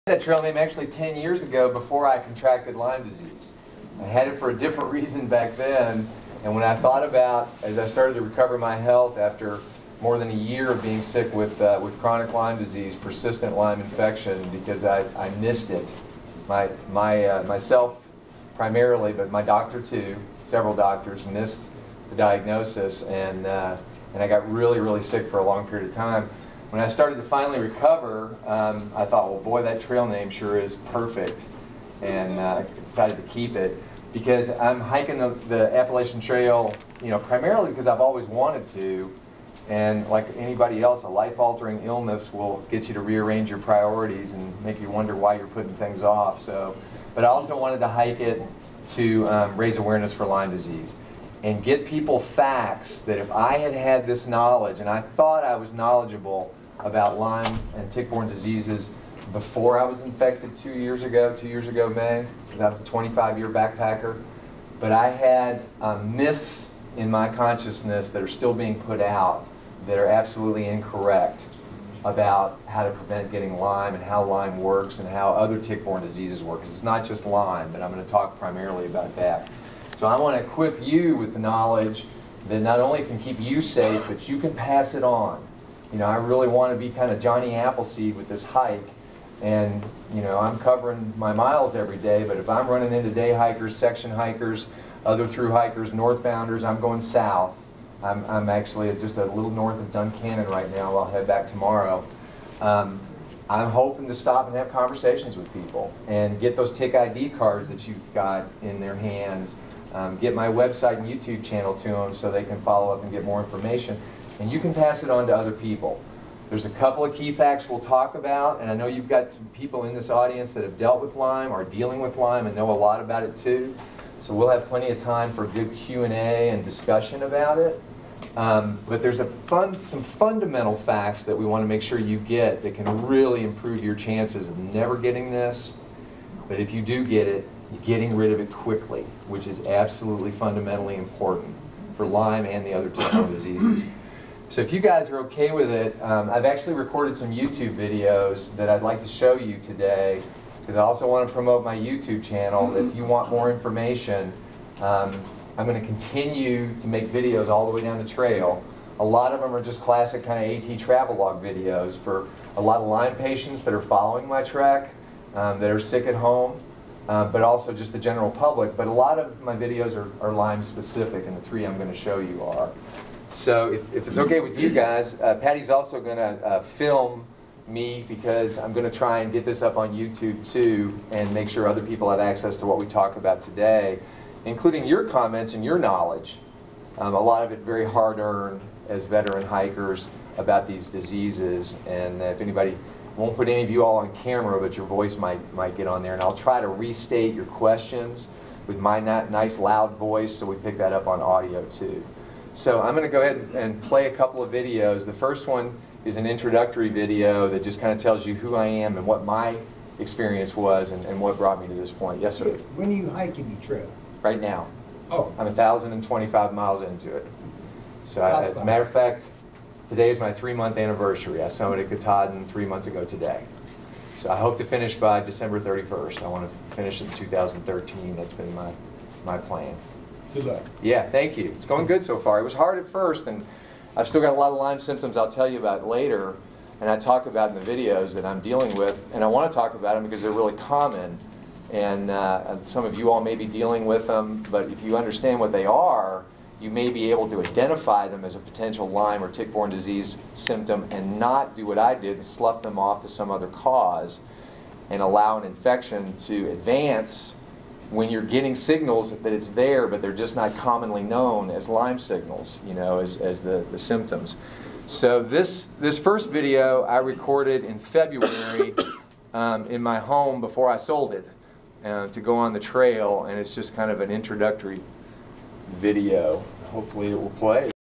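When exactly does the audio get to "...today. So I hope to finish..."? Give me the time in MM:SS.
03:43.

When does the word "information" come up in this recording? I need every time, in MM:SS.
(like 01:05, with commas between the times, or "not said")
01:53, 02:33.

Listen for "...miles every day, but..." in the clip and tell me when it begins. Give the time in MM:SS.
01:31.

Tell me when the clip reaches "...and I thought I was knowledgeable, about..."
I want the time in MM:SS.
00:54.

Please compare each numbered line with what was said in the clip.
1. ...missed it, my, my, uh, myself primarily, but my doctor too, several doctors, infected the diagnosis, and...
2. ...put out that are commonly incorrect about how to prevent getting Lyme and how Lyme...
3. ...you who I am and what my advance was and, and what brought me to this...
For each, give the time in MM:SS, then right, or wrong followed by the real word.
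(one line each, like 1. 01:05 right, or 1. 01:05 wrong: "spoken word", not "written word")
1. 00:15 wrong: "missed", not "infected"
2. 01:08 wrong: "absolutely", not "commonly"
3. 03:28 wrong: "experience", not "advance".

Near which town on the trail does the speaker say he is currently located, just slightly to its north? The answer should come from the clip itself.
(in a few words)
Duncannon.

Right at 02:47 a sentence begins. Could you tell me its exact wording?
Uh, but also just the general public.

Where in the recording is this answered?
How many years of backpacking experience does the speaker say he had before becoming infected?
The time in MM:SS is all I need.
01:02.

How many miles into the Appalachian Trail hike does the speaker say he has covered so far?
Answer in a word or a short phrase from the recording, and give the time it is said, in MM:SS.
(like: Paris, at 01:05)
1,025, at 03:35.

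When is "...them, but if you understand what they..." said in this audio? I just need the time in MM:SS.
04:04.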